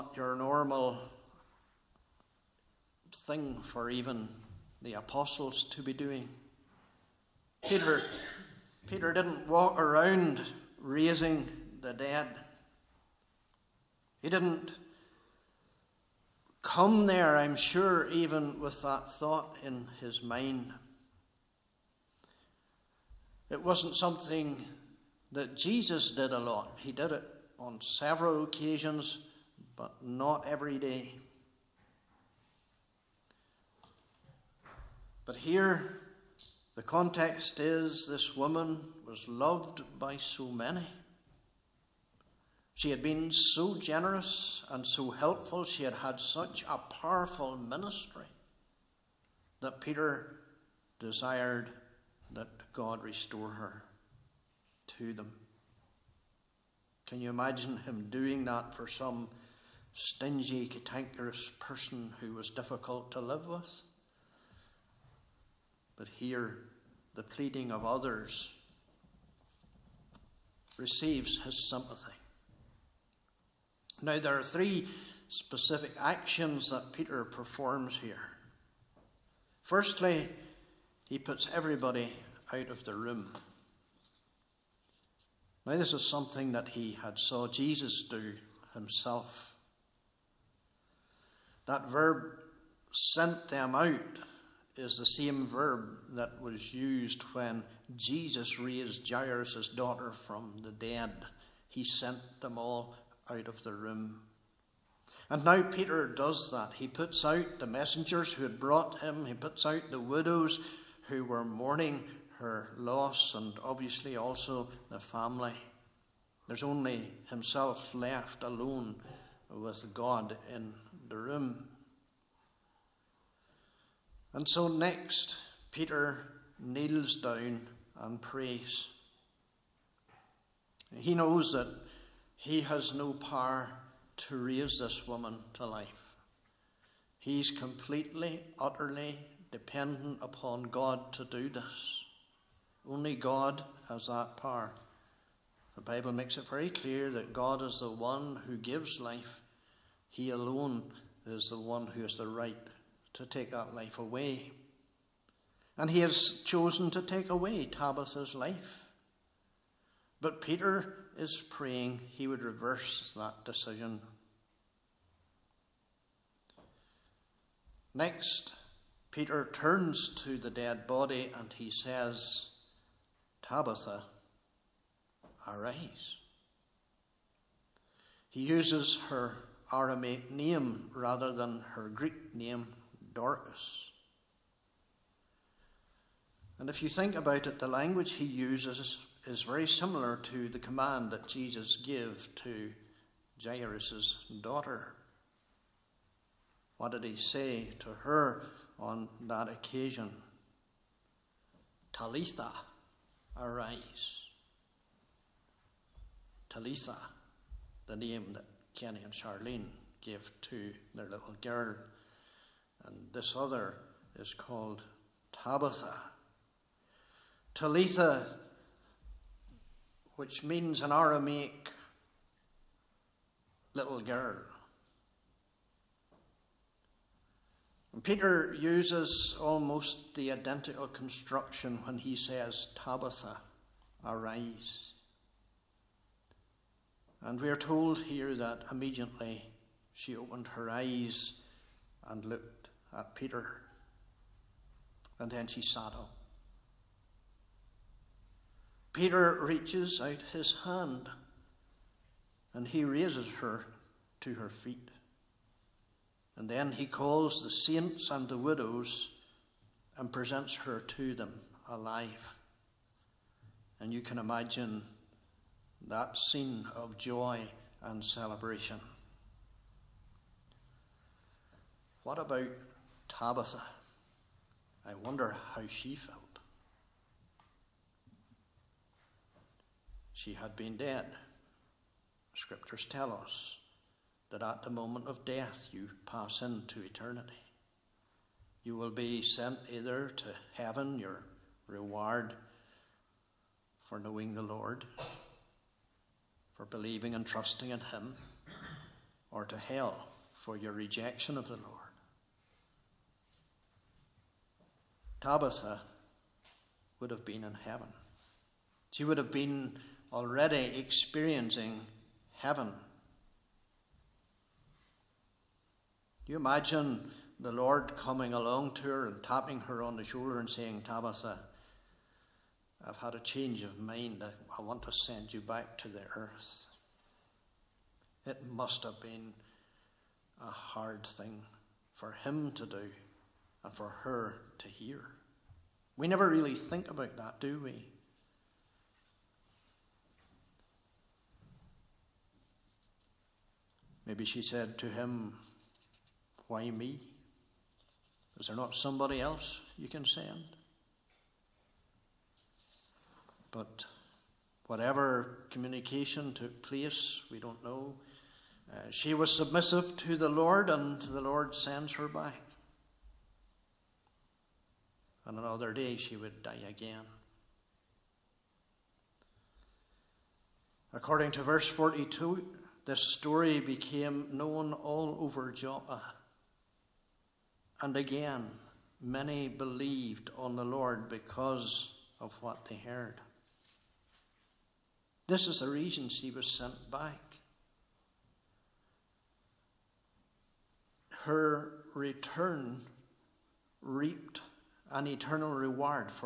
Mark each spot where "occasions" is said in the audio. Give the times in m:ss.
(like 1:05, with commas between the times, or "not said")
0:28, 3:19.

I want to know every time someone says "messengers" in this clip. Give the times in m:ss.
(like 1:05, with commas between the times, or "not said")
1:47.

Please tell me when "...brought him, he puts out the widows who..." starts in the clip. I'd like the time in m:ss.
1:48.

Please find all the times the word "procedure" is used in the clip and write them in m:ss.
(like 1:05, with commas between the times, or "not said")
not said.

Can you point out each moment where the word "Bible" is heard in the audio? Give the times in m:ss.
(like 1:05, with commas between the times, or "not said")
2:25.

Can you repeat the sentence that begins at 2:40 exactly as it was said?
But Peter is praying he would reverse that decision.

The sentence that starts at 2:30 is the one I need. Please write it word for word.
He alone is the one who has the right to take that life away.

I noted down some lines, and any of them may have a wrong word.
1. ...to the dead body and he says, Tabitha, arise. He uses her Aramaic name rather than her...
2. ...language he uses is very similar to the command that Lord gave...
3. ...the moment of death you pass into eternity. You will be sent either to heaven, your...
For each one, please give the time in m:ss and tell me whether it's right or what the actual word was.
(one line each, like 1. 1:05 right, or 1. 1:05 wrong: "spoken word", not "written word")
1. 2:50 right
2. 3:07 wrong: "Jesus", not "Lord"
3. 4:44 right.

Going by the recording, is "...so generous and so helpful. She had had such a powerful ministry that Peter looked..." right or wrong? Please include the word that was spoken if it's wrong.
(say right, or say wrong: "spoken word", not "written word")
wrong: "desired", not "looked".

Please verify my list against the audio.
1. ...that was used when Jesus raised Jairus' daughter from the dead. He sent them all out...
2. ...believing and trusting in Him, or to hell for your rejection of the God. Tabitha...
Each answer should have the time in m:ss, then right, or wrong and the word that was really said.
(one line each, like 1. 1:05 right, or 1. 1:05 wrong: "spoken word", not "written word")
1. 1:36 right
2. 4:56 wrong: "Lord", not "God".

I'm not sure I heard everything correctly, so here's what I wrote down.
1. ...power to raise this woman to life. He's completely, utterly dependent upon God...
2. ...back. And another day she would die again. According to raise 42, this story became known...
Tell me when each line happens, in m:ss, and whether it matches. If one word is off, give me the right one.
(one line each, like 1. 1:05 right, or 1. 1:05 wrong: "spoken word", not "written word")
1. 2:13 right
2. 6:02 wrong: "verse", not "raise".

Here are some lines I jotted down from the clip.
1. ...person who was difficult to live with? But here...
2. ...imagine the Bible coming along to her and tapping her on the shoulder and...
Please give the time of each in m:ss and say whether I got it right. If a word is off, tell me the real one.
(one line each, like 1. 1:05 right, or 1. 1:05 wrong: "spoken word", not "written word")
1. 1:01 right
2. 5:16 wrong: "Lord", not "Bible".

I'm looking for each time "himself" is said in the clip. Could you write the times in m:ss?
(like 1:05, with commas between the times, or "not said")
1:28, 1:57.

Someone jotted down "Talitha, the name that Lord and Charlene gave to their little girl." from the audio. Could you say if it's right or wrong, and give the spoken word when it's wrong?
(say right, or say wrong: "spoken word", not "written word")
wrong: "Kenny", not "Lord".